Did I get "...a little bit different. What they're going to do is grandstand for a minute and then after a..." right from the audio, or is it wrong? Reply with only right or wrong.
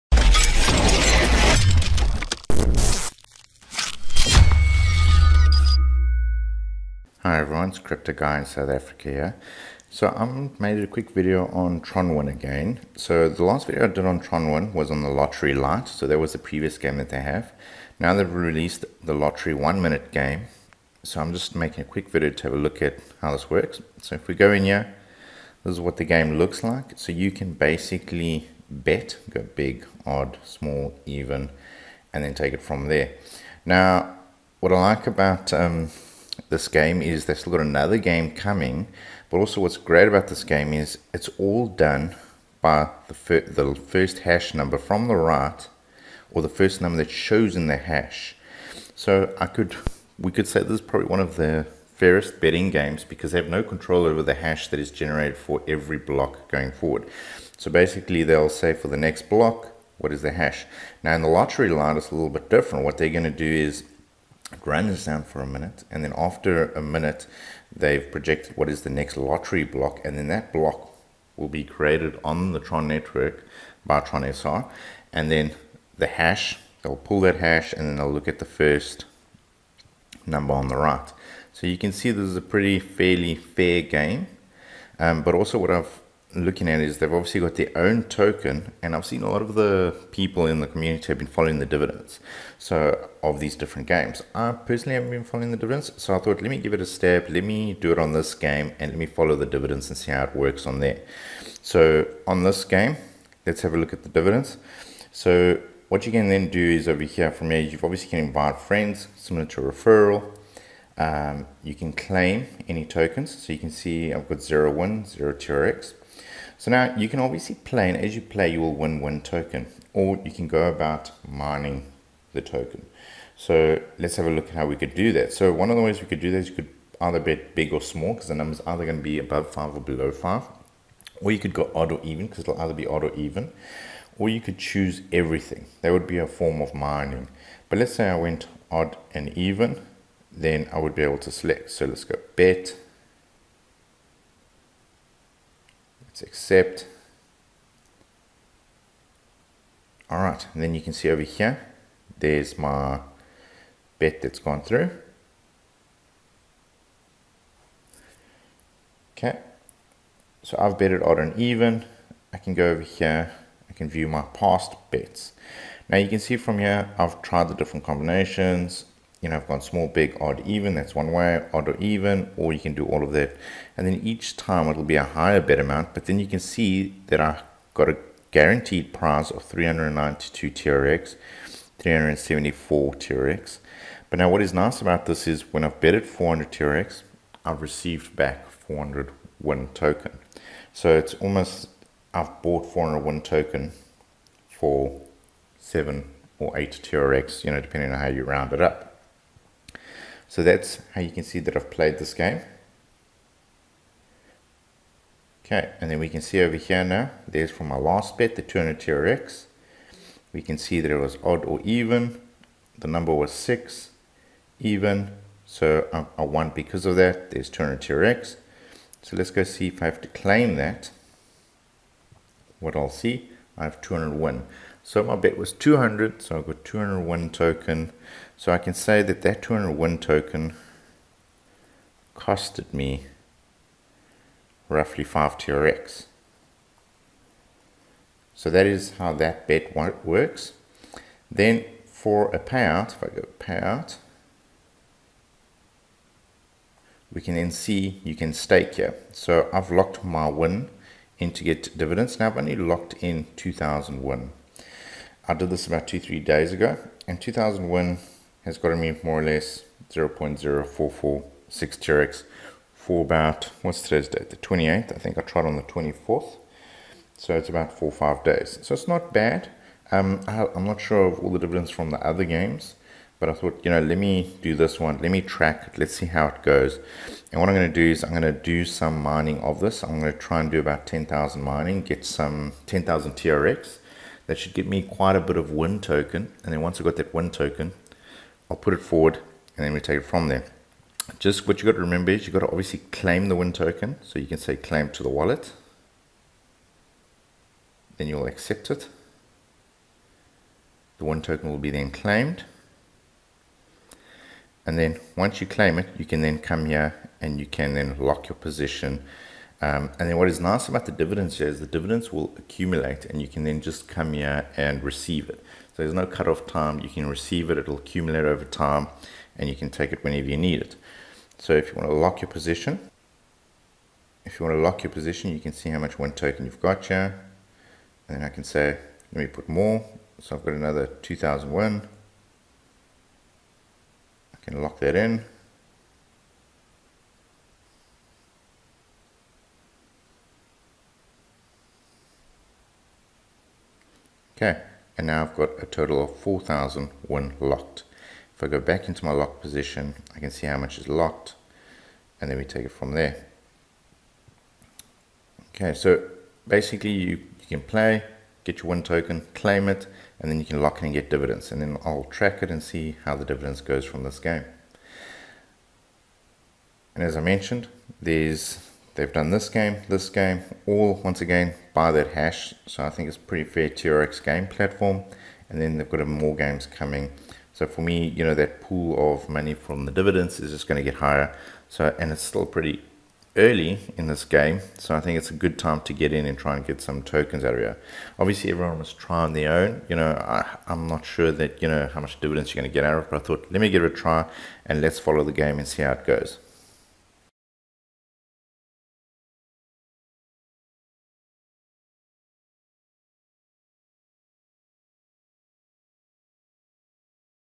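right.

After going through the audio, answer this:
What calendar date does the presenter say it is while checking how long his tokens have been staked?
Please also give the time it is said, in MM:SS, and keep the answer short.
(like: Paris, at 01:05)
The 28th, at 04:24.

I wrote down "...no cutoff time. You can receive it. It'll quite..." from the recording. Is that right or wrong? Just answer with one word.
wrong.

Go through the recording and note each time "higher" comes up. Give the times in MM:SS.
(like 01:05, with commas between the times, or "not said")
02:55, 06:20.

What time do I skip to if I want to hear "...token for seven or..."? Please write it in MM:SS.
03:13.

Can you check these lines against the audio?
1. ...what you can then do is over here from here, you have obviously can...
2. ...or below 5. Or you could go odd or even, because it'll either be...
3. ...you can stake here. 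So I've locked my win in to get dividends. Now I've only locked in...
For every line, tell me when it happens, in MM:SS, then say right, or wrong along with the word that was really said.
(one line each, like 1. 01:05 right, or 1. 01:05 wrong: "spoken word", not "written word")
1. 01:45 right
2. 02:09 right
3. 04:08 right.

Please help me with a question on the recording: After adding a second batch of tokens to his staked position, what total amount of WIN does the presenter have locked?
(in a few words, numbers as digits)
4,001.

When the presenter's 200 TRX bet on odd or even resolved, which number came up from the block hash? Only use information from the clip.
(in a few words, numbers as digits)
6.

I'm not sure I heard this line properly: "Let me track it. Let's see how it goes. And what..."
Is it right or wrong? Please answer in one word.
right.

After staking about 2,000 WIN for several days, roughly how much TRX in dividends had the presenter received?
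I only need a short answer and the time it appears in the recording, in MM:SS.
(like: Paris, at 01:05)
0.0446 TRX, at 04:19.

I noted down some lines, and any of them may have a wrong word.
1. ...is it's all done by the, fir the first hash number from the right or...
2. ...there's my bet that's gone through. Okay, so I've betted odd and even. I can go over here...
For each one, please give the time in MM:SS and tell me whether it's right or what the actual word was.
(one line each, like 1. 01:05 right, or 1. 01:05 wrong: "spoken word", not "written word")
1. 00:40 right
2. 02:32 right.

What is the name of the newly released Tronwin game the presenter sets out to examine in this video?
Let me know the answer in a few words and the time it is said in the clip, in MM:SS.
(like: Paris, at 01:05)
Lottery One Minute, at 00:19.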